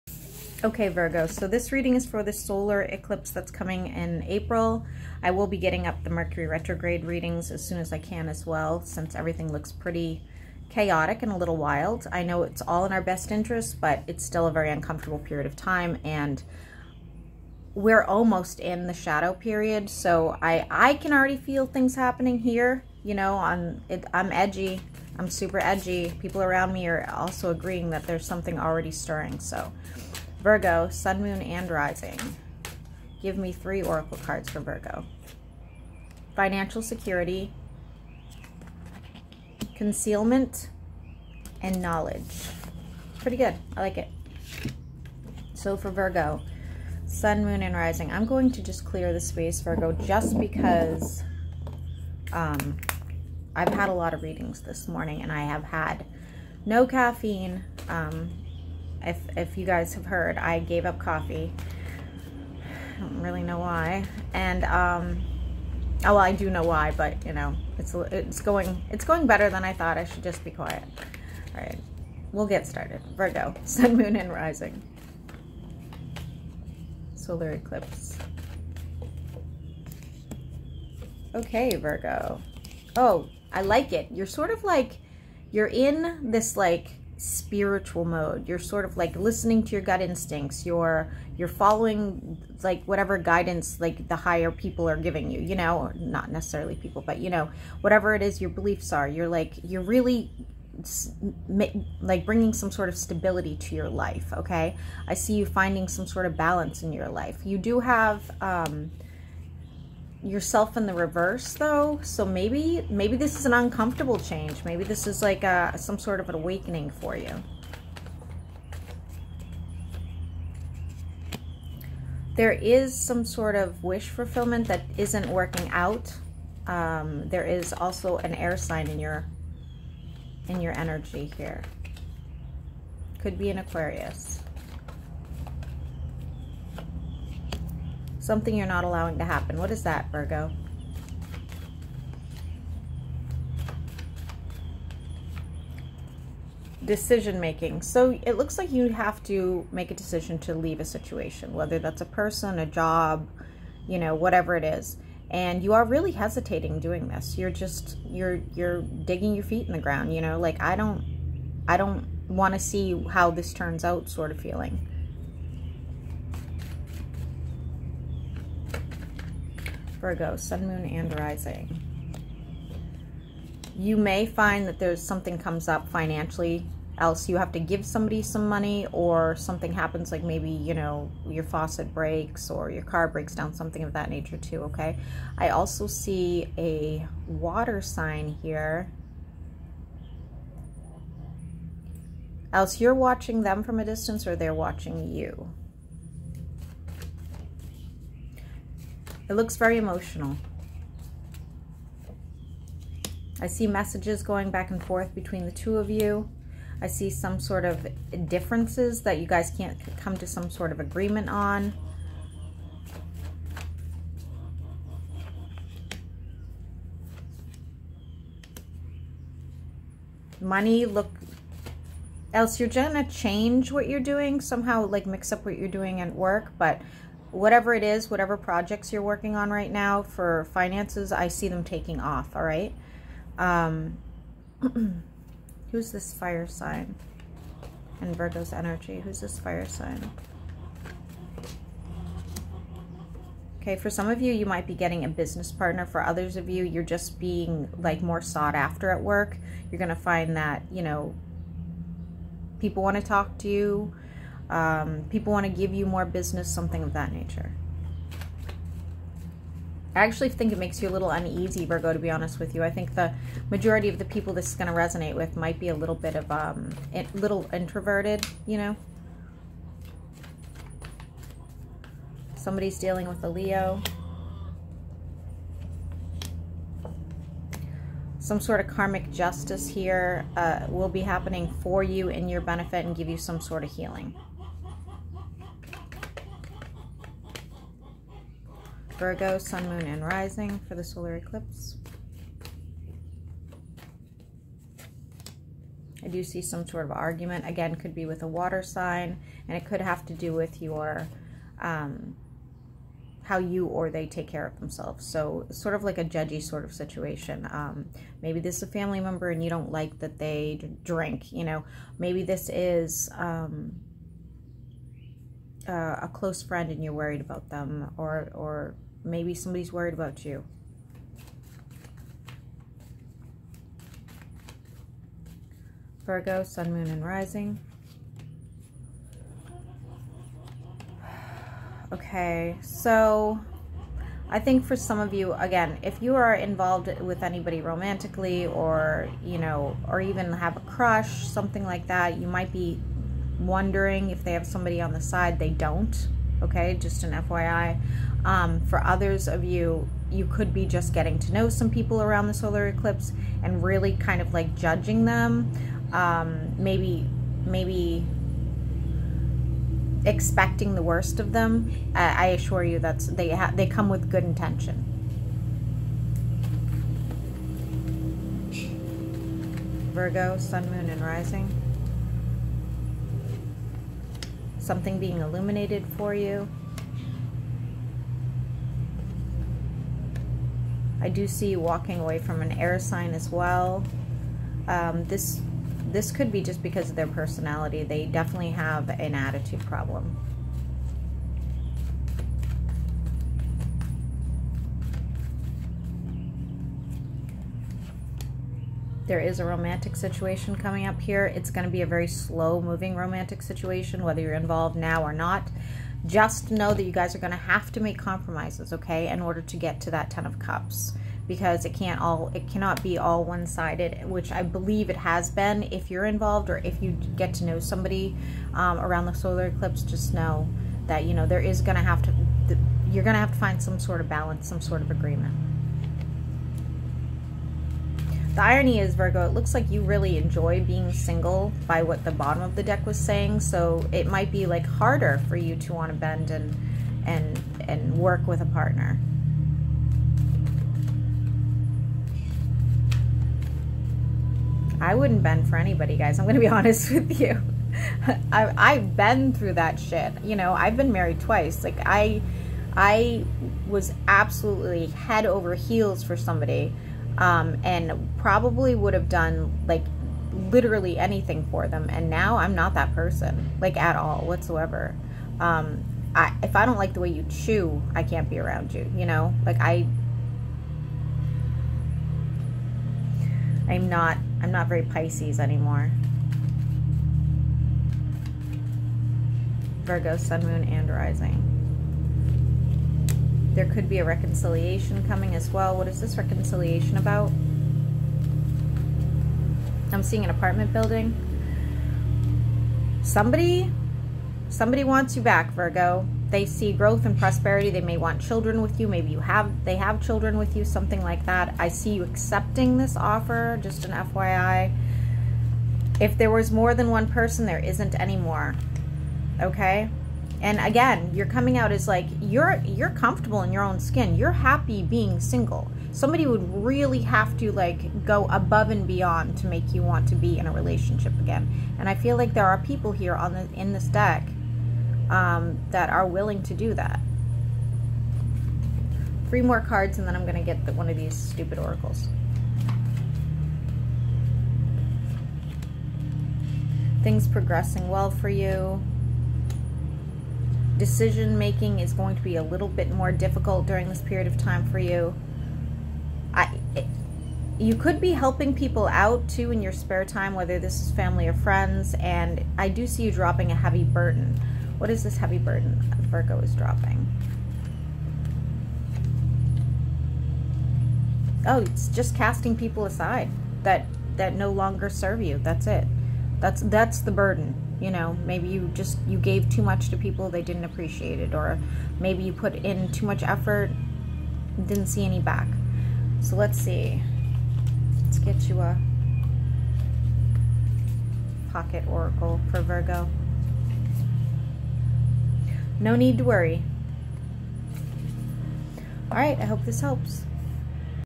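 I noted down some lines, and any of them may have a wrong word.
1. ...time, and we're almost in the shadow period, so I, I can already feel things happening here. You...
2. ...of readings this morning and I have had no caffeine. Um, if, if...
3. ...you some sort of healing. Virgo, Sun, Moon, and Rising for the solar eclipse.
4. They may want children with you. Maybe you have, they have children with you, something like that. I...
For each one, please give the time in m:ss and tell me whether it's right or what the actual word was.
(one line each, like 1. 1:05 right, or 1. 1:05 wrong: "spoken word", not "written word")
1. 0:15 right
2. 0:54 right
3. 4:43 right
4. 8:17 right.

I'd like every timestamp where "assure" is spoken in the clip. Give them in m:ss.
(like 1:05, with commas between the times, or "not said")
6:02.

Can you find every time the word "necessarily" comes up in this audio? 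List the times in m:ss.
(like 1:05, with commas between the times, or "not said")
1:36.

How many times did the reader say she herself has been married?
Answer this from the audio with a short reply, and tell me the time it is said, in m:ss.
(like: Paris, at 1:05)
2, at 7:31.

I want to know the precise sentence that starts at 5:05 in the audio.
So sort of like a judgy sort of situation.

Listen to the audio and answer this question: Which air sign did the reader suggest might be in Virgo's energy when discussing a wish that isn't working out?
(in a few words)
Aquarius.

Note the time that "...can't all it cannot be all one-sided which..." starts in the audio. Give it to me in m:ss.
6:51.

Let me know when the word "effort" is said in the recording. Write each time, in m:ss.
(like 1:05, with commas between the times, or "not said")
9:33.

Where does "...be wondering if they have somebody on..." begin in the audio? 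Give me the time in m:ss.
5:42.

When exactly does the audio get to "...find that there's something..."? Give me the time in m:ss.
2:54.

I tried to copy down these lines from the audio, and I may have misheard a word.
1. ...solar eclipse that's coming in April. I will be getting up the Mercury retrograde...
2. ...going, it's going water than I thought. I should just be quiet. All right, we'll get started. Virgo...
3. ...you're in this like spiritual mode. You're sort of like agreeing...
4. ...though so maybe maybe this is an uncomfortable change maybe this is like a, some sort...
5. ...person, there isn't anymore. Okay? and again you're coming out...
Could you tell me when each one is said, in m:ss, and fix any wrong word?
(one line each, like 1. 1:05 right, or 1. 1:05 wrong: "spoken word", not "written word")
1. 0:02 right
2. 1:08 wrong: "better", not "water"
3. 1:25 wrong: "listening", not "agreeing"
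4. 1:51 right
5. 8:27 right.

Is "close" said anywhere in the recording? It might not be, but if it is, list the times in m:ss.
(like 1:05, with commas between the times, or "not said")
5:16.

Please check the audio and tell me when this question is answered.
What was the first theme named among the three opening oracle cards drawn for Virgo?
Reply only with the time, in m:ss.
0:36.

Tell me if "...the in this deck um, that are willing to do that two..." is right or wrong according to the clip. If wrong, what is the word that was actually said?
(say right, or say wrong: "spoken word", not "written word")
wrong: "three", not "two".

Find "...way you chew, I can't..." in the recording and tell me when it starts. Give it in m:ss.
7:46.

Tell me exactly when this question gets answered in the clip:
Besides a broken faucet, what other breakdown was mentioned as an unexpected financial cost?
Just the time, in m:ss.
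3:02.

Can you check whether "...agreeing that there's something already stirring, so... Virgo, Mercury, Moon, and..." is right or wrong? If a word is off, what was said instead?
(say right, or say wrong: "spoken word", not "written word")
wrong: "Sun", not "Mercury".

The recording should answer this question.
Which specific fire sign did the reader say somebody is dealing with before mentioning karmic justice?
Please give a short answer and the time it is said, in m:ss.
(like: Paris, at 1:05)
Leo, at 4:33.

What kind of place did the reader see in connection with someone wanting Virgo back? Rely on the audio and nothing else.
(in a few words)
apartment building.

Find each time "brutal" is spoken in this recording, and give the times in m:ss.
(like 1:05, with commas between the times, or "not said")
not said.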